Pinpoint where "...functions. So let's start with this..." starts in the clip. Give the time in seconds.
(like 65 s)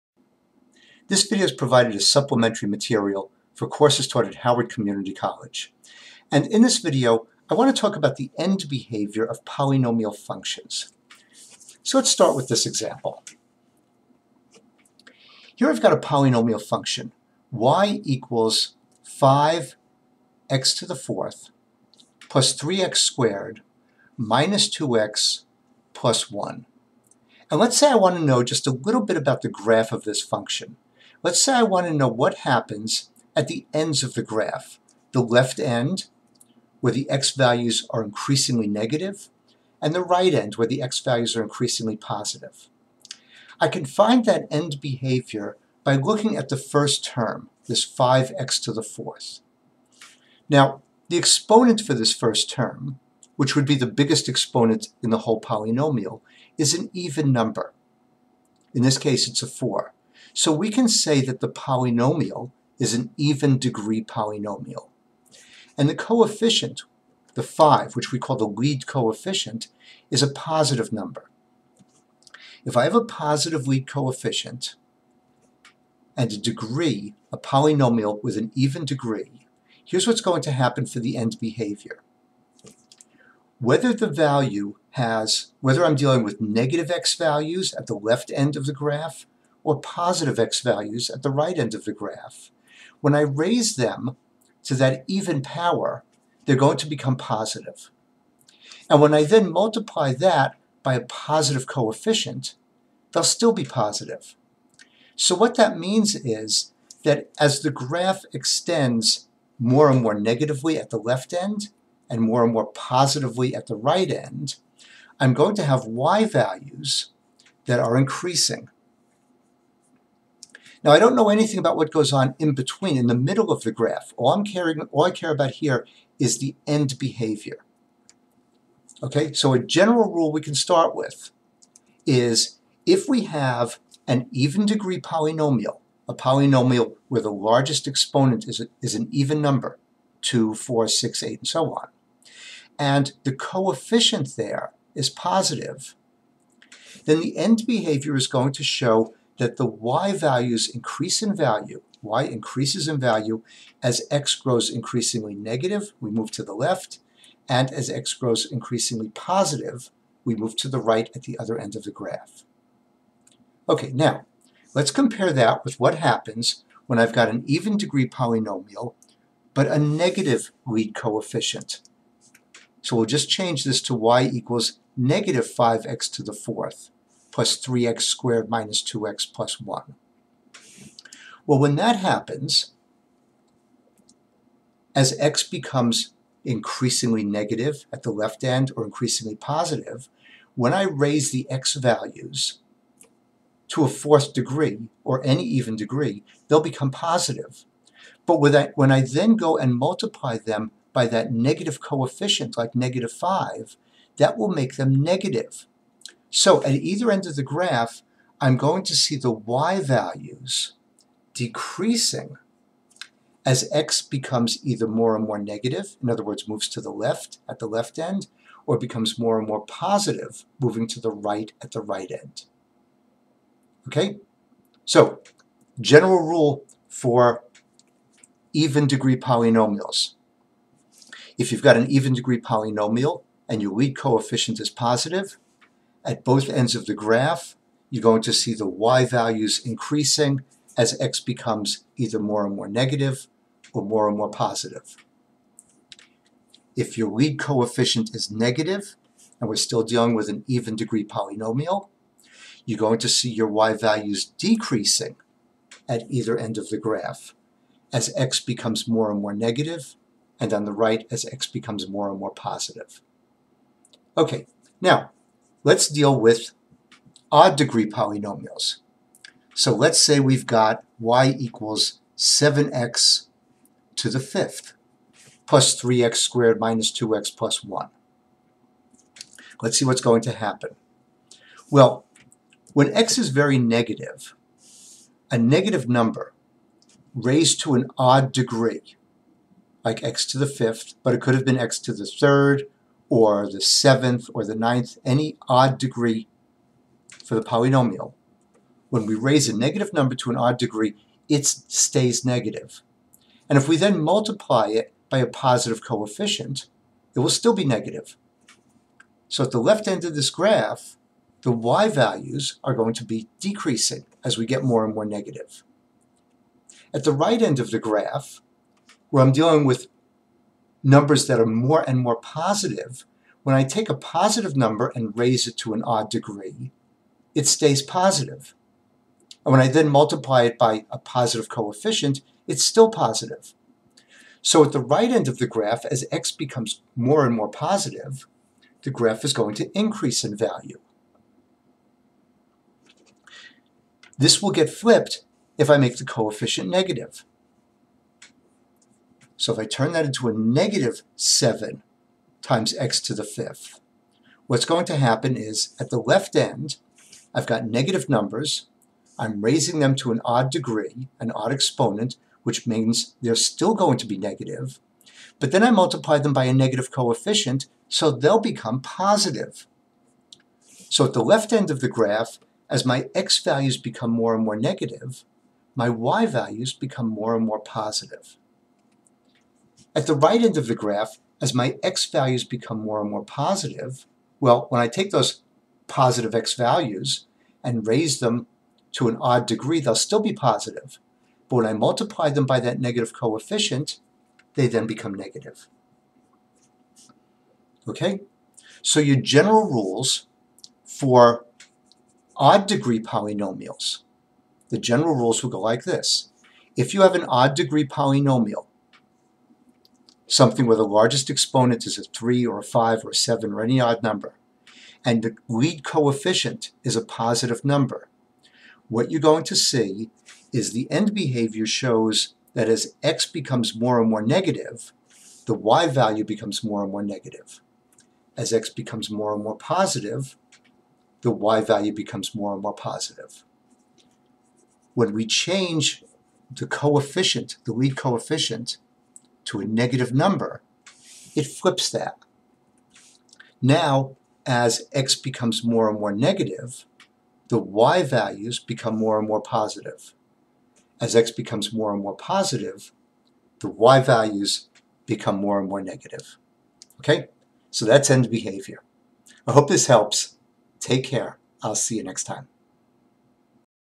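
10 s.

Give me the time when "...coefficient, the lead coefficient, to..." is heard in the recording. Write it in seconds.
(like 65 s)
436 s.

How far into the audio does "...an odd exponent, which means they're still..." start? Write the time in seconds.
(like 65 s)
361 s.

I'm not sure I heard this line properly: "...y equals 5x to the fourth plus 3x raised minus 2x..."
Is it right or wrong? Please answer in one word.
wrong.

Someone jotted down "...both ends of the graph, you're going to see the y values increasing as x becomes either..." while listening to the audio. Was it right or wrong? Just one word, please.
right.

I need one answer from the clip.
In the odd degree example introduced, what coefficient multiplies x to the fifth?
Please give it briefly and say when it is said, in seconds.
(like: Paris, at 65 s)
7, at 272 s.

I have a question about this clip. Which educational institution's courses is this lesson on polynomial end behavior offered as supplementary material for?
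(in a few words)
Howard Community College.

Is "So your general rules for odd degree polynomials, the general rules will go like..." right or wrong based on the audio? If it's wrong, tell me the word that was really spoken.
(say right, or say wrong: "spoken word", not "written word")
right.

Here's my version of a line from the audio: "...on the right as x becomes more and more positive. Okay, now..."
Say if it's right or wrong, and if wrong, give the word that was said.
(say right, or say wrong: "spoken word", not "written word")
right.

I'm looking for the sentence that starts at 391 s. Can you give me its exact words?
But when I multiply them by that negative coefficient, they then become negative.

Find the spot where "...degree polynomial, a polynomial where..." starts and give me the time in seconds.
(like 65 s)
134 s.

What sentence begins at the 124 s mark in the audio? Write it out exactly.
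All, I'm caring, all I care about here is the end behavior.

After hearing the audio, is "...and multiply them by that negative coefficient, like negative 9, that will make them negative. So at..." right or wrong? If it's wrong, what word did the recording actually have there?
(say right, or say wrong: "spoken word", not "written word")
wrong: "5", not "9".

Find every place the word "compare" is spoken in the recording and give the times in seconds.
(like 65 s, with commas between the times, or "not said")
164 s.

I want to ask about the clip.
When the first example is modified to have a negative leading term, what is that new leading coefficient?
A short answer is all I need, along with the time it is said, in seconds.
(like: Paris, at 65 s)
-5, at 174 s.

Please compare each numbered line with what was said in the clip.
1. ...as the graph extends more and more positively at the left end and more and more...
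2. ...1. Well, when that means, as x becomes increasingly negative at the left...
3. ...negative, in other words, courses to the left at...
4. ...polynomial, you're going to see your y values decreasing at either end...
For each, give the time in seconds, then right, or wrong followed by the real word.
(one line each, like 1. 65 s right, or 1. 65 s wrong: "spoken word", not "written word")
1. 107 s wrong: "negatively", not "positively"
2. 179 s wrong: "happens", not "means"
3. 215 s wrong: "moves", not "courses"
4. 251 s right.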